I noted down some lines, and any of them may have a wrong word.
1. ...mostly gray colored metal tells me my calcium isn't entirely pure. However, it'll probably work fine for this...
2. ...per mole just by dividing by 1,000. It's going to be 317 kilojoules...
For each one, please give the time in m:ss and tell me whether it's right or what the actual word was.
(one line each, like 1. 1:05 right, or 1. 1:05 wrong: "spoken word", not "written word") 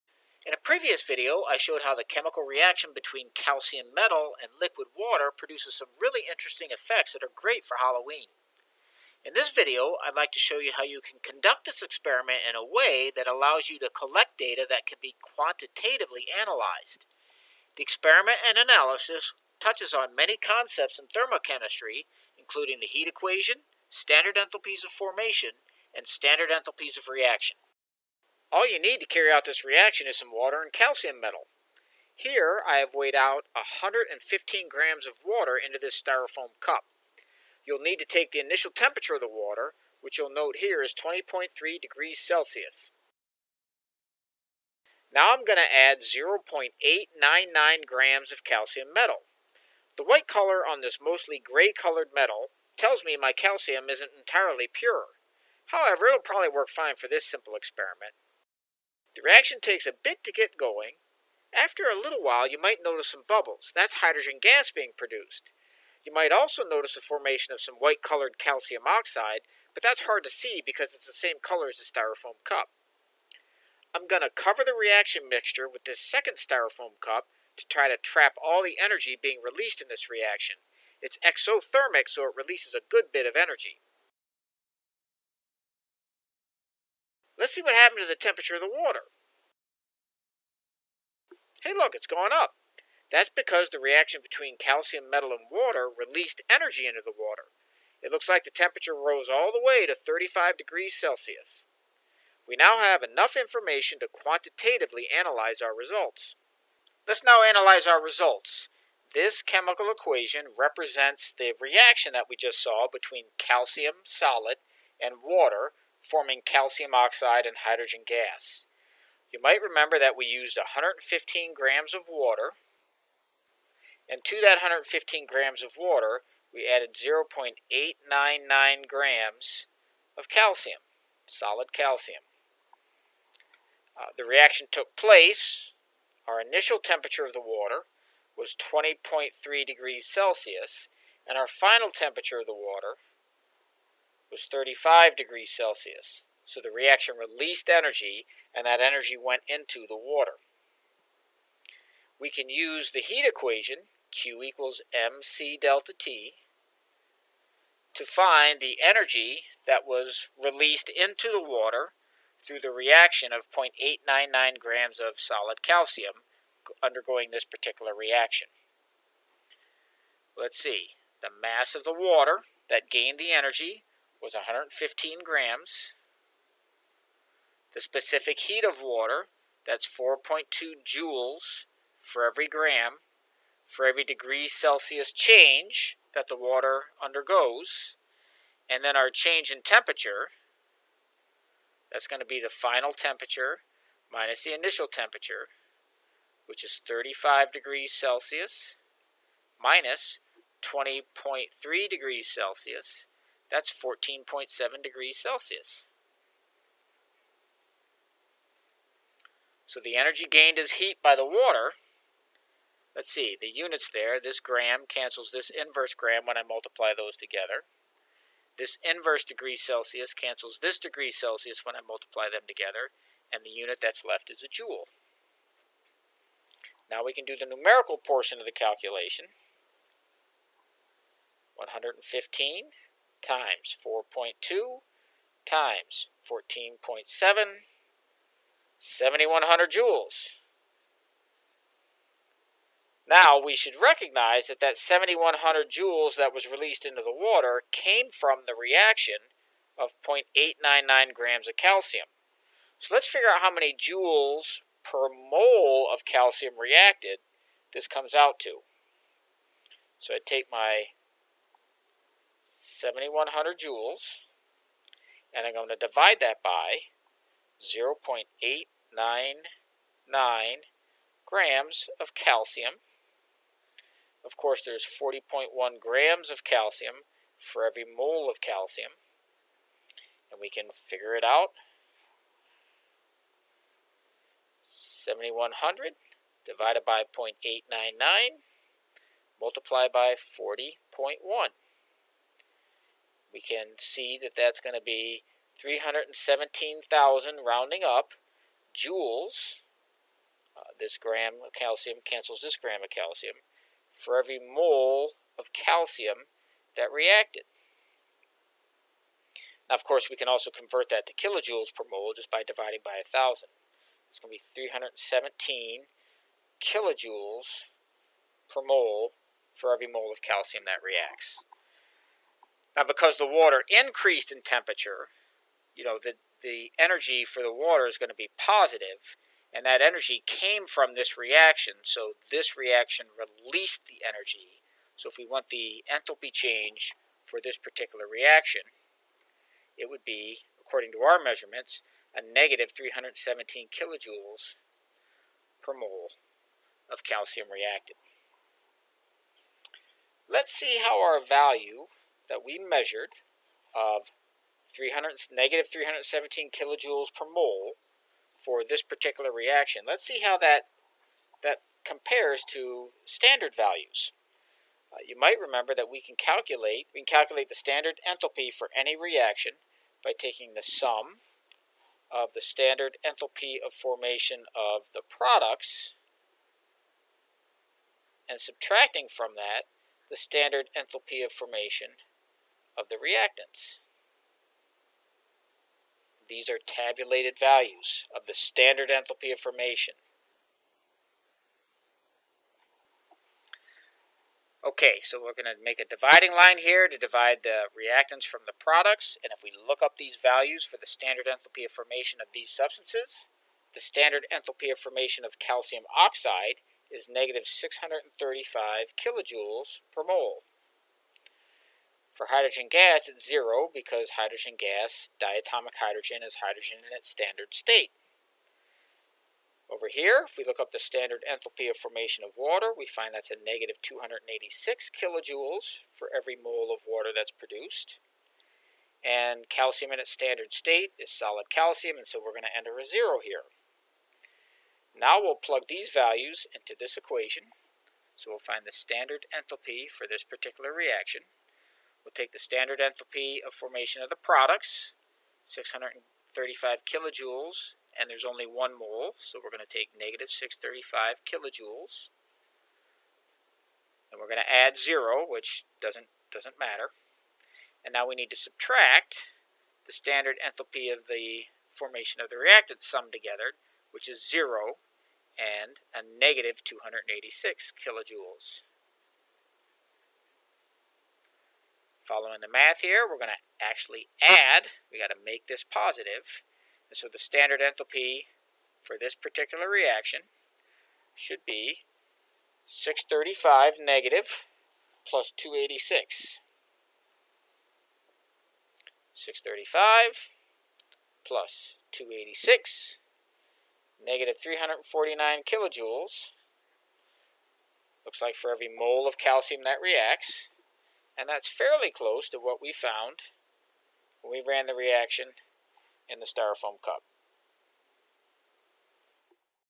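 1. 0:51 right
2. 5:11 right.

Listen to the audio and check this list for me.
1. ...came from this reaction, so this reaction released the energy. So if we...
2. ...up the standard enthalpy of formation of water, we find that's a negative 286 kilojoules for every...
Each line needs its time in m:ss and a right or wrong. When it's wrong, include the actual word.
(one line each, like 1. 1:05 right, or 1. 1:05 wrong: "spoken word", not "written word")
1. 5:30 right
2. 7:00 right.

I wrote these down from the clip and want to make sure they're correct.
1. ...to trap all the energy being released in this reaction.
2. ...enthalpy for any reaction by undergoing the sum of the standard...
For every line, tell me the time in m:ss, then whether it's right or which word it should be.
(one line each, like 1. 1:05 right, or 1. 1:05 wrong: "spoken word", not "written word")
1. 1:17 right
2. 6:08 wrong: "taking", not "undergoing".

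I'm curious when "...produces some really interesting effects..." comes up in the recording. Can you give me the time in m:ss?
0:05.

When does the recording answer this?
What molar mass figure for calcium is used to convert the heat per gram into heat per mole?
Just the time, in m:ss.
4:34.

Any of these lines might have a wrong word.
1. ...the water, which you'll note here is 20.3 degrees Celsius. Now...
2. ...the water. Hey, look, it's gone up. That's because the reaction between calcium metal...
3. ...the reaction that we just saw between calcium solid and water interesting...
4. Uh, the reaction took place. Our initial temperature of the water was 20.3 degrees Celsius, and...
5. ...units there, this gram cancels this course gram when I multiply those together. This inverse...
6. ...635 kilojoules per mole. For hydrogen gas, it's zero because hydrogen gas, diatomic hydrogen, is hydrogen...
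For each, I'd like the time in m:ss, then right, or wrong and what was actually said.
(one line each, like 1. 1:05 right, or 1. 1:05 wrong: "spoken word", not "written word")
1. 0:39 right
2. 1:28 right
3. 1:51 wrong: "forming", not "interesting"
4. 2:13 right
5. 3:33 wrong: "inverse", not "course"
6. 6:47 right.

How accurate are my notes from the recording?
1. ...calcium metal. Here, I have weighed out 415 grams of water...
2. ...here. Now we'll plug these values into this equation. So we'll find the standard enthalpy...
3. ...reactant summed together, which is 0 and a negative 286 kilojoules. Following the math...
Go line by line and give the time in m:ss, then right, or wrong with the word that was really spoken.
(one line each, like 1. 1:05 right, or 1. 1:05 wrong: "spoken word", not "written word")
1. 0:30 wrong: "115", not "415"
2. 7:13 right
3. 7:42 right.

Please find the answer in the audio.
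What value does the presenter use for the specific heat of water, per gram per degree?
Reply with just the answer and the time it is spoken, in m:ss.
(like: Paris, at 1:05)
4.2 joules, at 2:59.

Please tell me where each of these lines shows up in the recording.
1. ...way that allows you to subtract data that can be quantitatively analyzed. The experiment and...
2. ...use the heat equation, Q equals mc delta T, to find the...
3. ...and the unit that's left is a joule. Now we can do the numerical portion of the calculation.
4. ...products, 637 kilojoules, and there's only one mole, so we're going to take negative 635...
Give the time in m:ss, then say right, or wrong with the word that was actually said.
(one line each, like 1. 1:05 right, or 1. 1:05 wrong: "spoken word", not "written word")
1. 0:12 wrong: "collect", not "subtract"
2. 2:32 right
3. 3:43 right
4. 7:24 wrong: "635", not "637".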